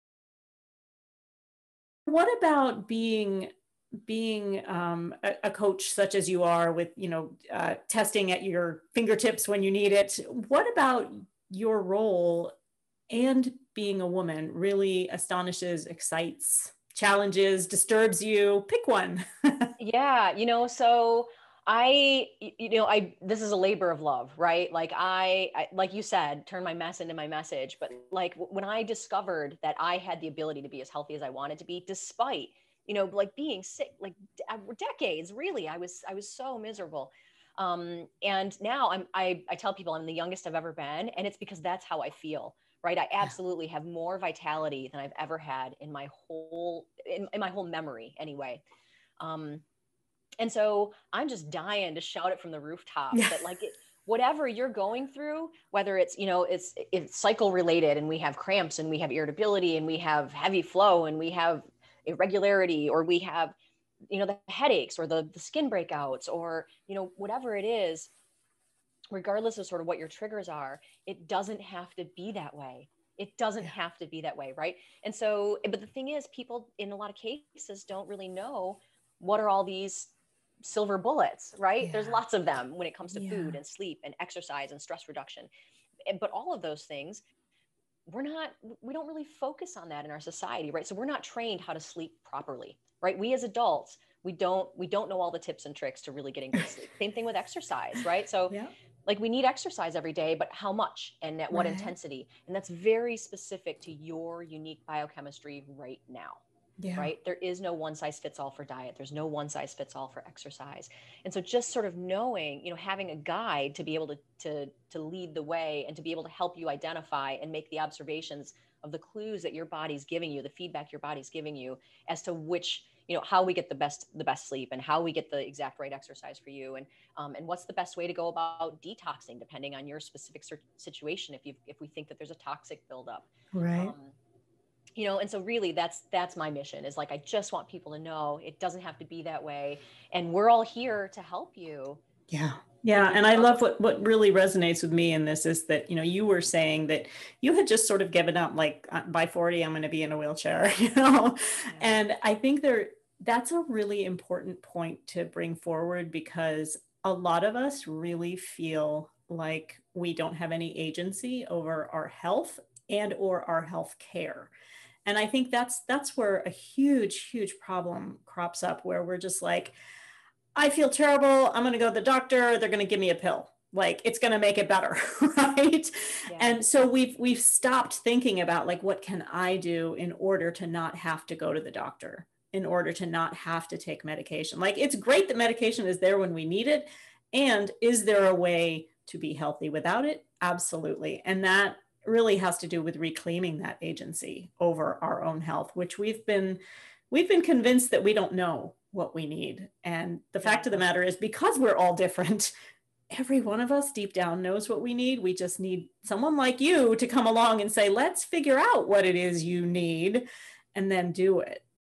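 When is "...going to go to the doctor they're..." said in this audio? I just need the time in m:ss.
2:51.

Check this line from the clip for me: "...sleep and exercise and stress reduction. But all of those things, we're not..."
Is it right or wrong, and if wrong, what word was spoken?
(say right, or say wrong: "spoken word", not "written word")
right.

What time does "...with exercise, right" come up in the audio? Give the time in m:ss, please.
1:37.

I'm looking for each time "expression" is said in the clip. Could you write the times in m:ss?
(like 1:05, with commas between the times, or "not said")
not said.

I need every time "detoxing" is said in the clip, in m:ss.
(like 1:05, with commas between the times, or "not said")
2:08.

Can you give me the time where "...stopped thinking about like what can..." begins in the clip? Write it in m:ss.
2:57.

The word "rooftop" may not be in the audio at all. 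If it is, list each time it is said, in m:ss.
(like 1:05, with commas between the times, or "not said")
0:52.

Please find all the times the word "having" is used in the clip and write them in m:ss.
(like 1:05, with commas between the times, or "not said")
1:52.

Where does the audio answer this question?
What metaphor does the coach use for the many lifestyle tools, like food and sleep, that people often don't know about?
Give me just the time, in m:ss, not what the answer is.
1:20.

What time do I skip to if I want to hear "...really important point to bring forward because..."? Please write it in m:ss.
2:33.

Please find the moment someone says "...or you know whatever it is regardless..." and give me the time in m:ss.
1:06.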